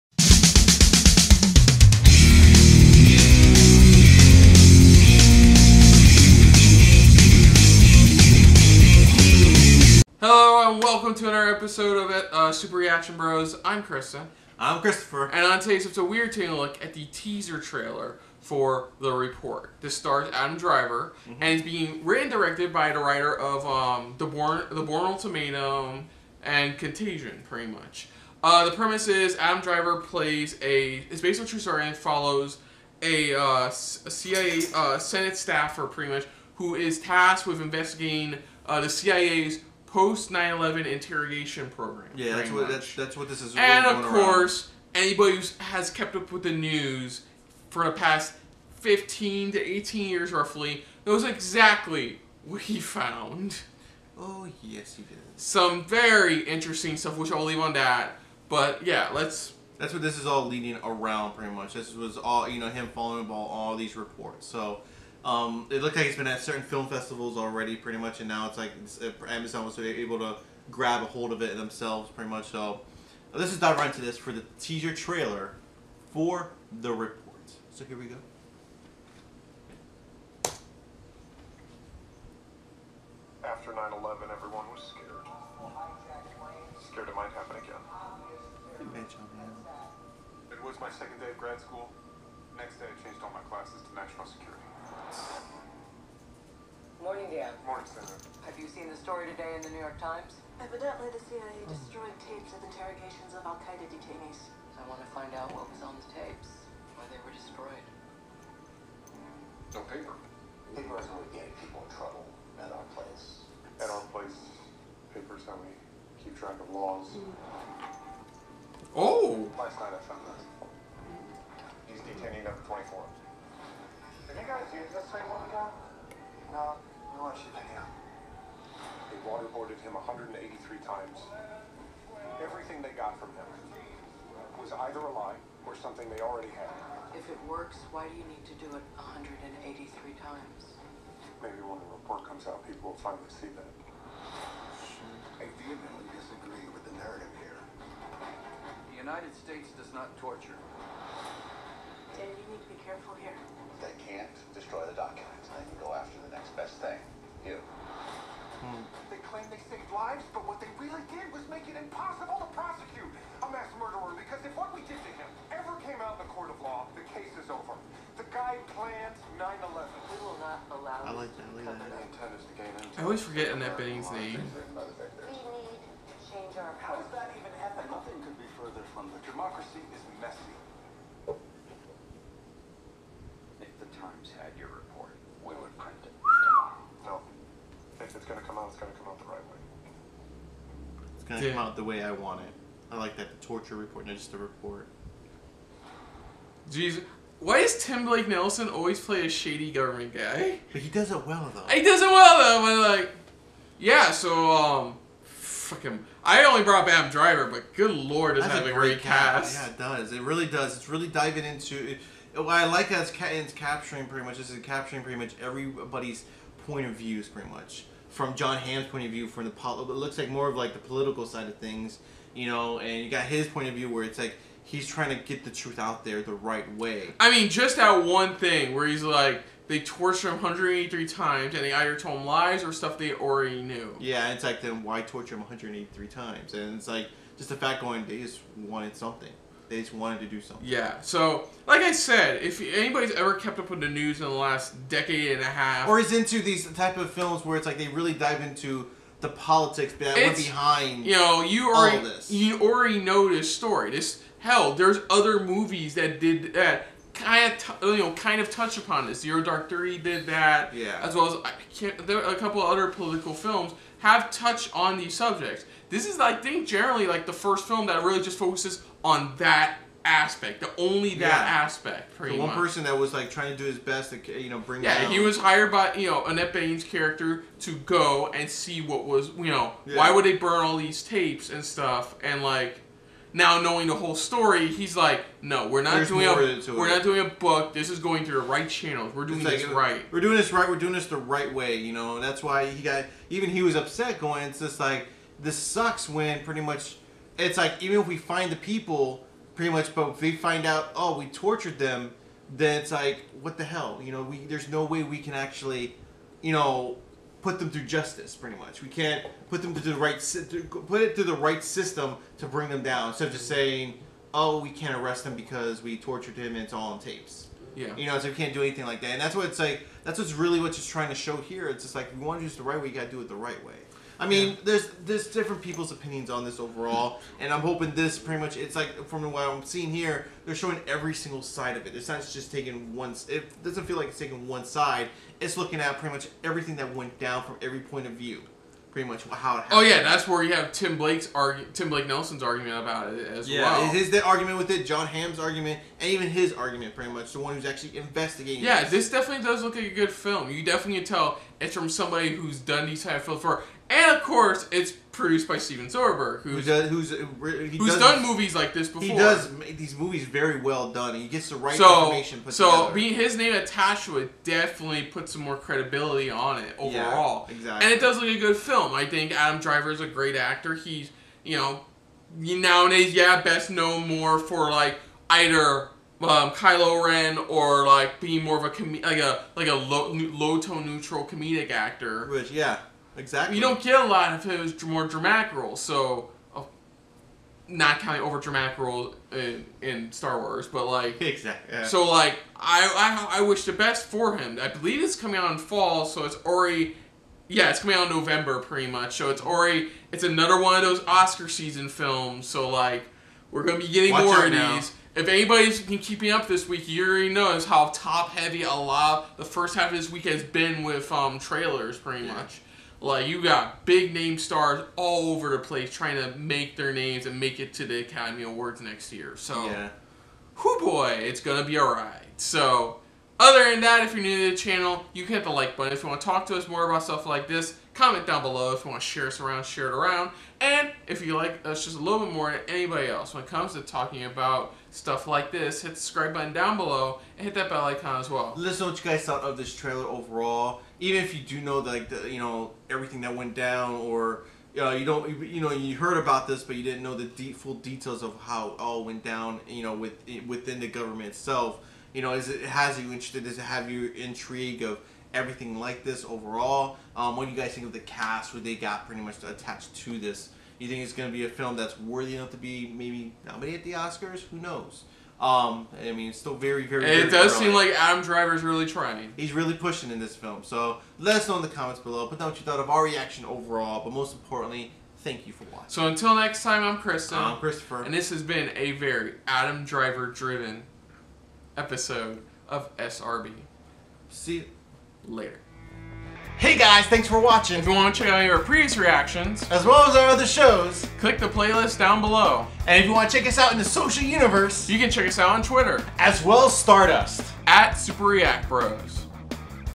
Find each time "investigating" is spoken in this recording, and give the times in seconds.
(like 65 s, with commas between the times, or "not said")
37 s, 347 s.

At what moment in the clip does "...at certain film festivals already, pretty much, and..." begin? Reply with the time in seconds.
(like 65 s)
66 s.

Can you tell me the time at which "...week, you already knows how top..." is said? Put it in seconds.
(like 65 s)
406 s.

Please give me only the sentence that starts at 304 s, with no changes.
You know, we, there's no way we can actually, you know, put them through justice, pretty much.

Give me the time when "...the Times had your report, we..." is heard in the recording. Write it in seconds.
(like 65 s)
183 s.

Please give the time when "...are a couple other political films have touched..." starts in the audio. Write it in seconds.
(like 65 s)
262 s.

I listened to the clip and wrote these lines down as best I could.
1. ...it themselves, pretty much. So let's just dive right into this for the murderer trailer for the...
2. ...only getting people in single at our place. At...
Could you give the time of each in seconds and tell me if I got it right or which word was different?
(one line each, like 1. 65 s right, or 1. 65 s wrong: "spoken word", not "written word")
1. 71 s wrong: "teaser", not "murderer"
2. 111 s wrong: "trouble", not "single".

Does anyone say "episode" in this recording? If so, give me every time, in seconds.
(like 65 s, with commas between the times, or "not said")
11 s, 15 s, 481 s.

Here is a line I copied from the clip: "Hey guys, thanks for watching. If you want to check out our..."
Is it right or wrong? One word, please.
right.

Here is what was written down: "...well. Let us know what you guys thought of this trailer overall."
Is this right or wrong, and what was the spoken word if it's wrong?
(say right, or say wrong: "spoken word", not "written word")
right.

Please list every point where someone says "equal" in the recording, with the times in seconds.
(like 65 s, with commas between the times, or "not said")
not said.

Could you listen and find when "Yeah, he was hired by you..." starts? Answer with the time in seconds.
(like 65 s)
274 s.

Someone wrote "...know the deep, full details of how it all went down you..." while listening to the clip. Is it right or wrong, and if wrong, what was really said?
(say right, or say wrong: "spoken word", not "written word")
right.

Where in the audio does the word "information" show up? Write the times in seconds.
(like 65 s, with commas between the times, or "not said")
362 s.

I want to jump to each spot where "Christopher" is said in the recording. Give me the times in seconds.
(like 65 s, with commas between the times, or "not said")
14 s, 477 s.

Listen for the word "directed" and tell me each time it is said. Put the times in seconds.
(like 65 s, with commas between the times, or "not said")
22 s.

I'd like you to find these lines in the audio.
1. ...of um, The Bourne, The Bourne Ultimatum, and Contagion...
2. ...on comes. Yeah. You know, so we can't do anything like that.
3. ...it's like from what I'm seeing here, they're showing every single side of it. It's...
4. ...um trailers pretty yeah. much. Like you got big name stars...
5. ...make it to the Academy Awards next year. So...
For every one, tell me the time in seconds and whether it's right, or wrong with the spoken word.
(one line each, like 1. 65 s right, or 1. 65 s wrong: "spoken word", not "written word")
1. 23 s right
2. 316 s wrong: "tapes", not "comes"
3. 328 s right
4. 411 s right
5. 417 s right.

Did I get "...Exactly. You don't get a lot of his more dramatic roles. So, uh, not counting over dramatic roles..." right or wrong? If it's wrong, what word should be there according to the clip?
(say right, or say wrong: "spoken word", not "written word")
right.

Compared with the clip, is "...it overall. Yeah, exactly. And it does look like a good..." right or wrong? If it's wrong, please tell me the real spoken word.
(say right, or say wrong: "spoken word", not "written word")
right.